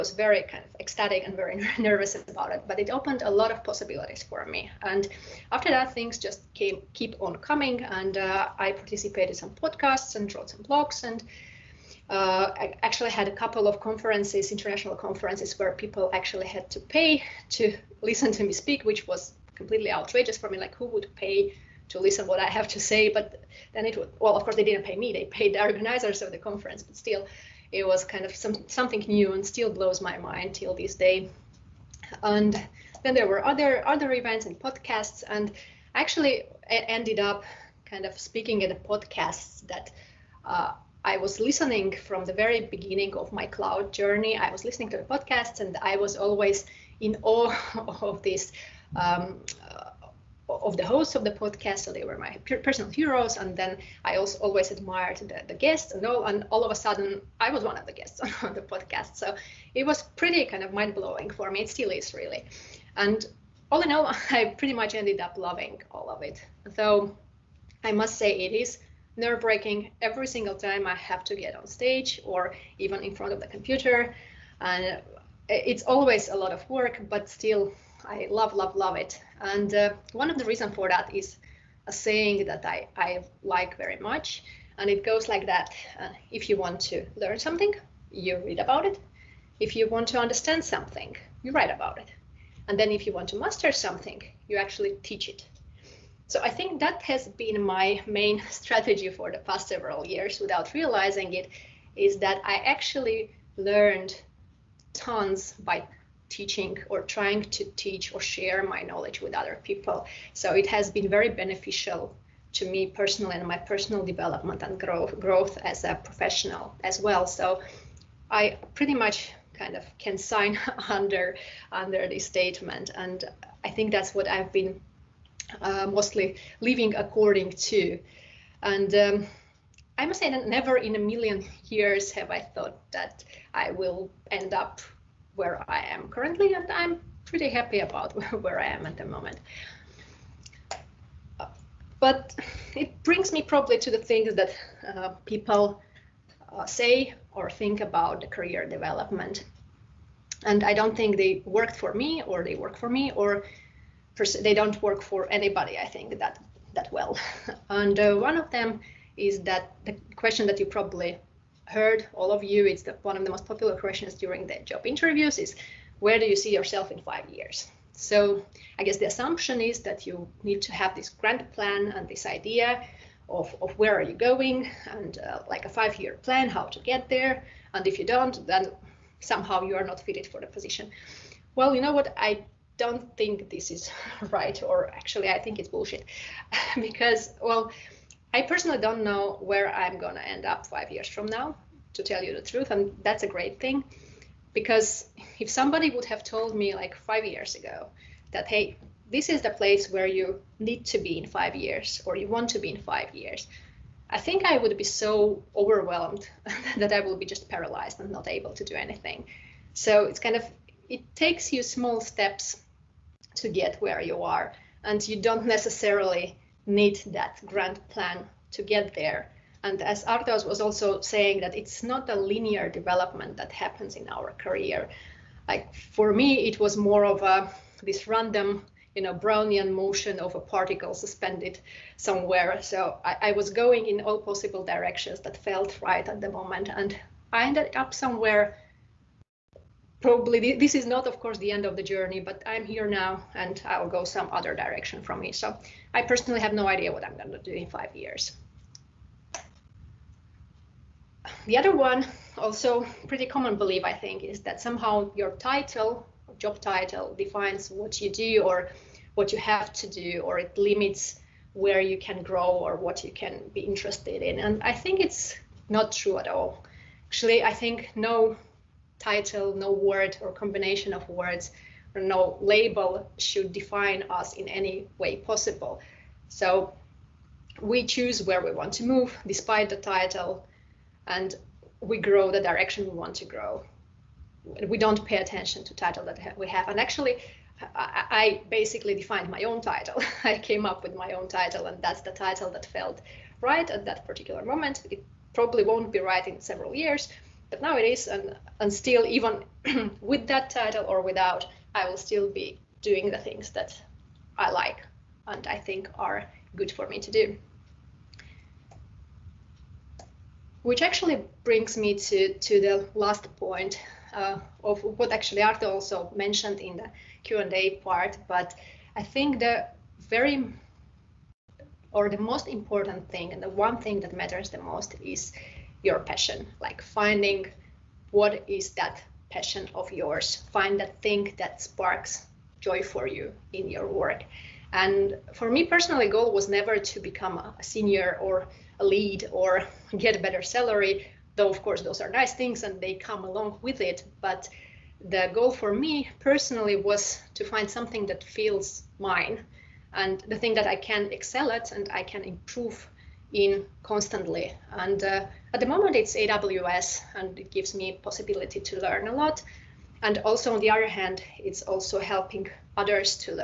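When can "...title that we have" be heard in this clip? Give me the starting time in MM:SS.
04:45.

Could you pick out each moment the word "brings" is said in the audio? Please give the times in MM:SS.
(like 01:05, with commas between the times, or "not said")
02:23, 05:11.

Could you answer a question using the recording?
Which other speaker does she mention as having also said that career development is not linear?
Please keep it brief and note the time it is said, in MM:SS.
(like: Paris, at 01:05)
Artos, at 03:40.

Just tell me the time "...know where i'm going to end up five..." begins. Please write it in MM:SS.
03:09.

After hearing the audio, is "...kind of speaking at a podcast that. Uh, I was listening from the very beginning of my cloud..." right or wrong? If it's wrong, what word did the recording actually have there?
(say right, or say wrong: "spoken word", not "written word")
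right.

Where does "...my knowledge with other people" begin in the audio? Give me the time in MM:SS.
01:48.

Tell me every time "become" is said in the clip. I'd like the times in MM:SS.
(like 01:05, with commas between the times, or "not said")
05:36.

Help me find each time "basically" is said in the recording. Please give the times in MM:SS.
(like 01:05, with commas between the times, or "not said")
04:48.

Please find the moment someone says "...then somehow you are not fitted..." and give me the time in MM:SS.
02:58.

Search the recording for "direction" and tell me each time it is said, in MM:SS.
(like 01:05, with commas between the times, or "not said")
03:54, 04:04, 04:42.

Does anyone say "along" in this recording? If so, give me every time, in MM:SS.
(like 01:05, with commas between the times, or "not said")
05:43.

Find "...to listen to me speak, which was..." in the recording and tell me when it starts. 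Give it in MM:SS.
00:17.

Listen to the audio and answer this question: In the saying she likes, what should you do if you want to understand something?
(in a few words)
Write about it.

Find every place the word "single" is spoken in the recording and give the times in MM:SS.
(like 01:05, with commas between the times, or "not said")
01:10.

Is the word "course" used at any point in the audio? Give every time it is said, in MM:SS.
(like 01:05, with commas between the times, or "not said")
00:24, 04:01, 05:41.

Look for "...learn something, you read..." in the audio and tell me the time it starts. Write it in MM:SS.
01:27.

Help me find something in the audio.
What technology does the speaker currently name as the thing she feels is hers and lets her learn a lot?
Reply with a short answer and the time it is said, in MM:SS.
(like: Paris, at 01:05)
AWS, at 05:56.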